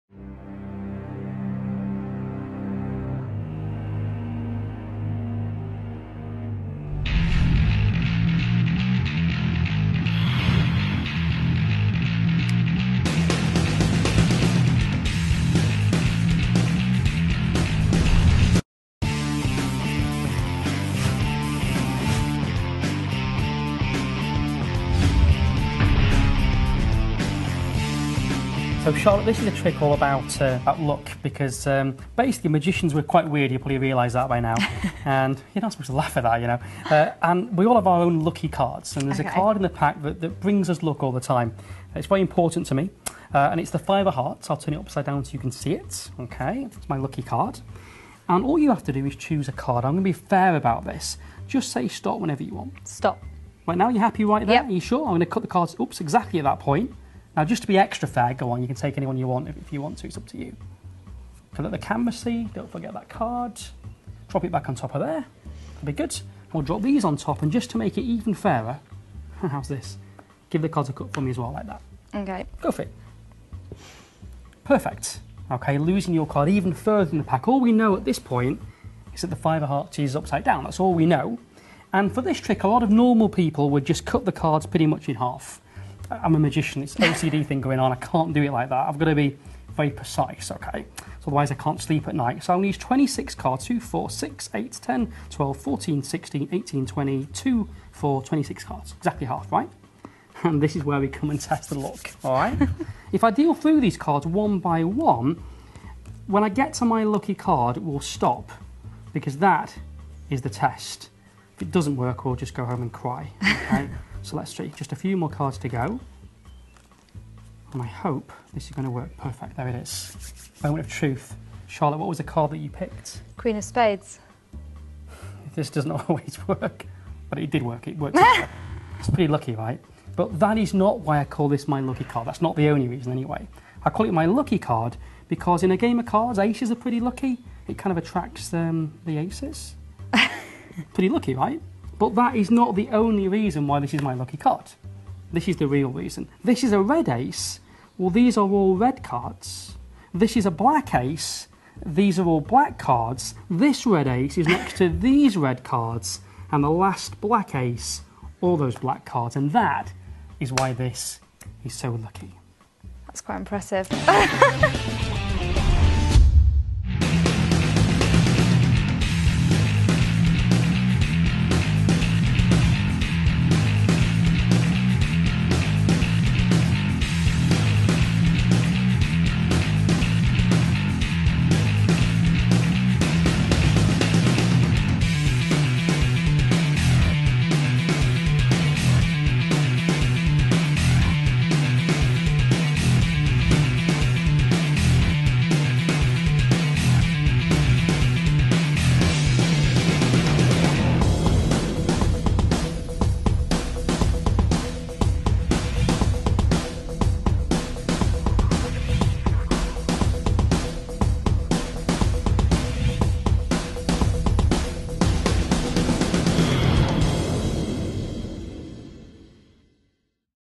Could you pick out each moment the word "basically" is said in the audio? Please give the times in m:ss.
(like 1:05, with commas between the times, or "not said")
0:32.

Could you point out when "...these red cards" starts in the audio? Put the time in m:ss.
2:34.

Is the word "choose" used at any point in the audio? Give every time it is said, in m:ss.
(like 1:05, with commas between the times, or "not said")
0:49.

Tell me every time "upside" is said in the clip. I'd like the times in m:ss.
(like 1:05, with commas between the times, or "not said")
0:44, 1:20.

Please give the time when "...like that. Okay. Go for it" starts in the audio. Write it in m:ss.
1:11.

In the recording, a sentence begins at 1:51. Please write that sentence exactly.
If it doesn't work, we'll just go home and cry, okay?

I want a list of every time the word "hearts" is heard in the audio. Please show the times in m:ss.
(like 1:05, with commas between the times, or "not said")
0:44, 1:19.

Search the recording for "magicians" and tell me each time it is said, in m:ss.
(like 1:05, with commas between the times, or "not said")
0:32, 1:26.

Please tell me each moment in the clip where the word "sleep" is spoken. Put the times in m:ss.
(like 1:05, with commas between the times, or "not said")
1:31.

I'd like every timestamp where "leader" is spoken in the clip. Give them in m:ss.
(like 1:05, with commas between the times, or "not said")
not said.